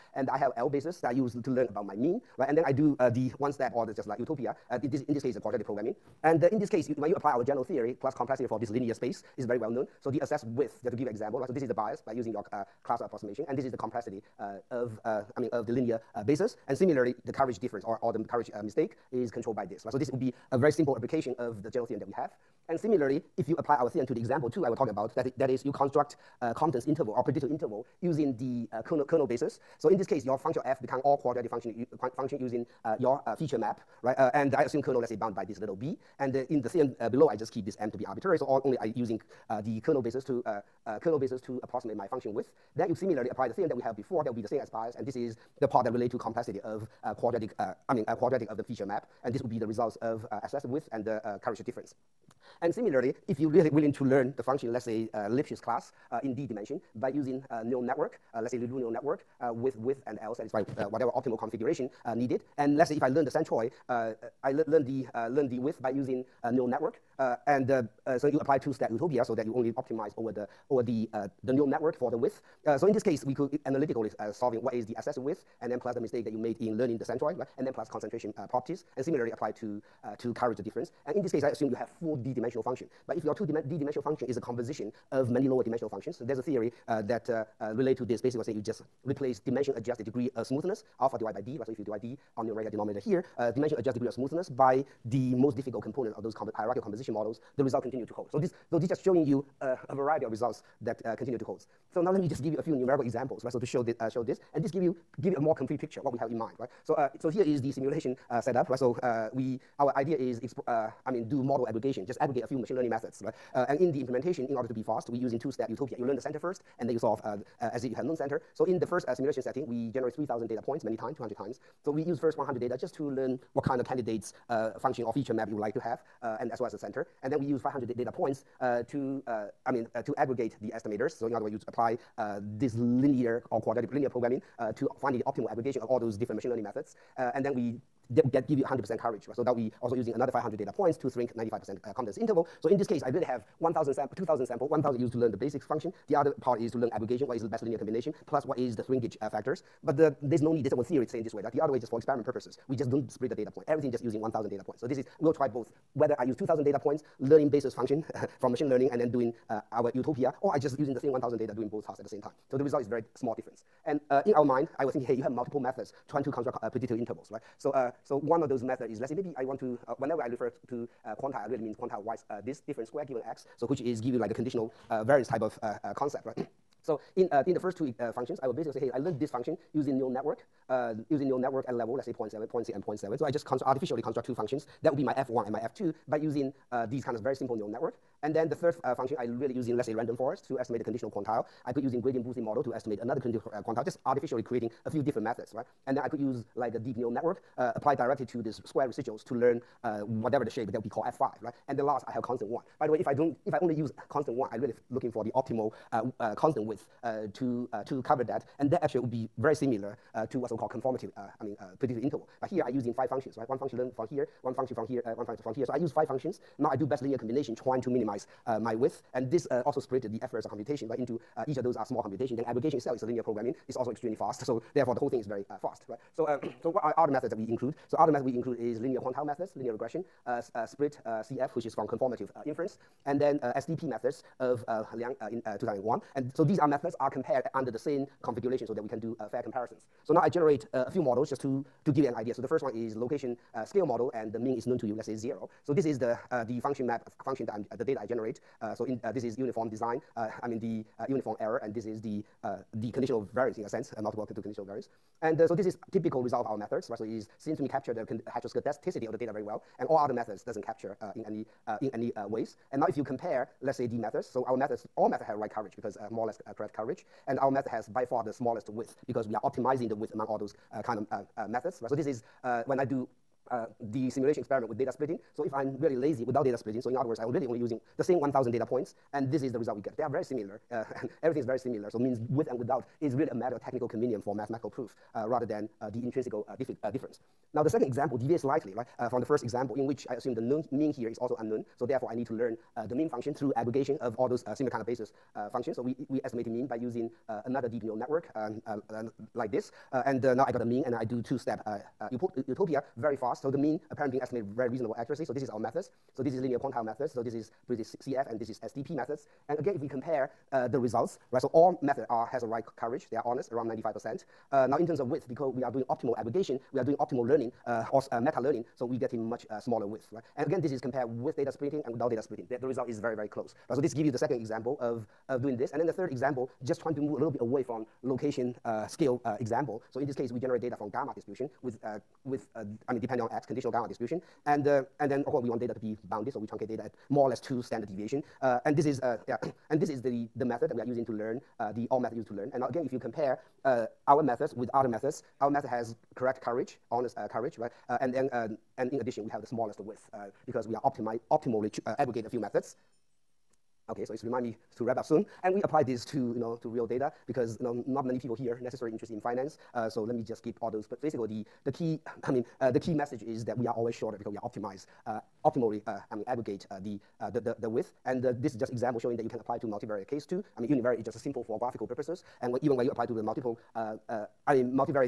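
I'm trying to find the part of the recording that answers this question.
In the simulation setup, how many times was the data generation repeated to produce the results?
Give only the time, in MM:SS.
02:01.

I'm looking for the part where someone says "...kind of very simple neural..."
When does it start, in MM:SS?
03:07.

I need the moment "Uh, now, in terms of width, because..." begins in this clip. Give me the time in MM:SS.
05:14.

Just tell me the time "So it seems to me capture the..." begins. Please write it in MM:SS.
04:16.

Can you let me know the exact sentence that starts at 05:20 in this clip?
And again, this is compared with data splitting and without data splitting.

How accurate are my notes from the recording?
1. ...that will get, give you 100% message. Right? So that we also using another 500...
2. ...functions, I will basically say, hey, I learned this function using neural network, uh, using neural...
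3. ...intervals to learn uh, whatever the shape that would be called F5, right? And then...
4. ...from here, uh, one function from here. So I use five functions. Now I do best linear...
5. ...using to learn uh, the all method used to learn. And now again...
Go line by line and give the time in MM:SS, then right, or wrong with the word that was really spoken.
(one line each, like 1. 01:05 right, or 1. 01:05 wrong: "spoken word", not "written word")
1. 02:18 wrong: "coverage", not "message"
2. 02:58 right
3. 03:18 wrong: "residuals", not "intervals"
4. 03:34 right
5. 05:40 right.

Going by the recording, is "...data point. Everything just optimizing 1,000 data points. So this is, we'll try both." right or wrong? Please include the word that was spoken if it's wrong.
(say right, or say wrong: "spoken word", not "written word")
wrong: "using", not "optimizing".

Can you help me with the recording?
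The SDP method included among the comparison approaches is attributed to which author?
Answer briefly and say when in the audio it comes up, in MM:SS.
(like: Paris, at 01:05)
Liang, at 03:54.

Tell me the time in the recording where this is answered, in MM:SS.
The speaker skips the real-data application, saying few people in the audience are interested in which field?
05:59.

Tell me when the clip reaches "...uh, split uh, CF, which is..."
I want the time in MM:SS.
03:50.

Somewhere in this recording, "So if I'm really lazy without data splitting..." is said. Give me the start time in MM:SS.
04:35.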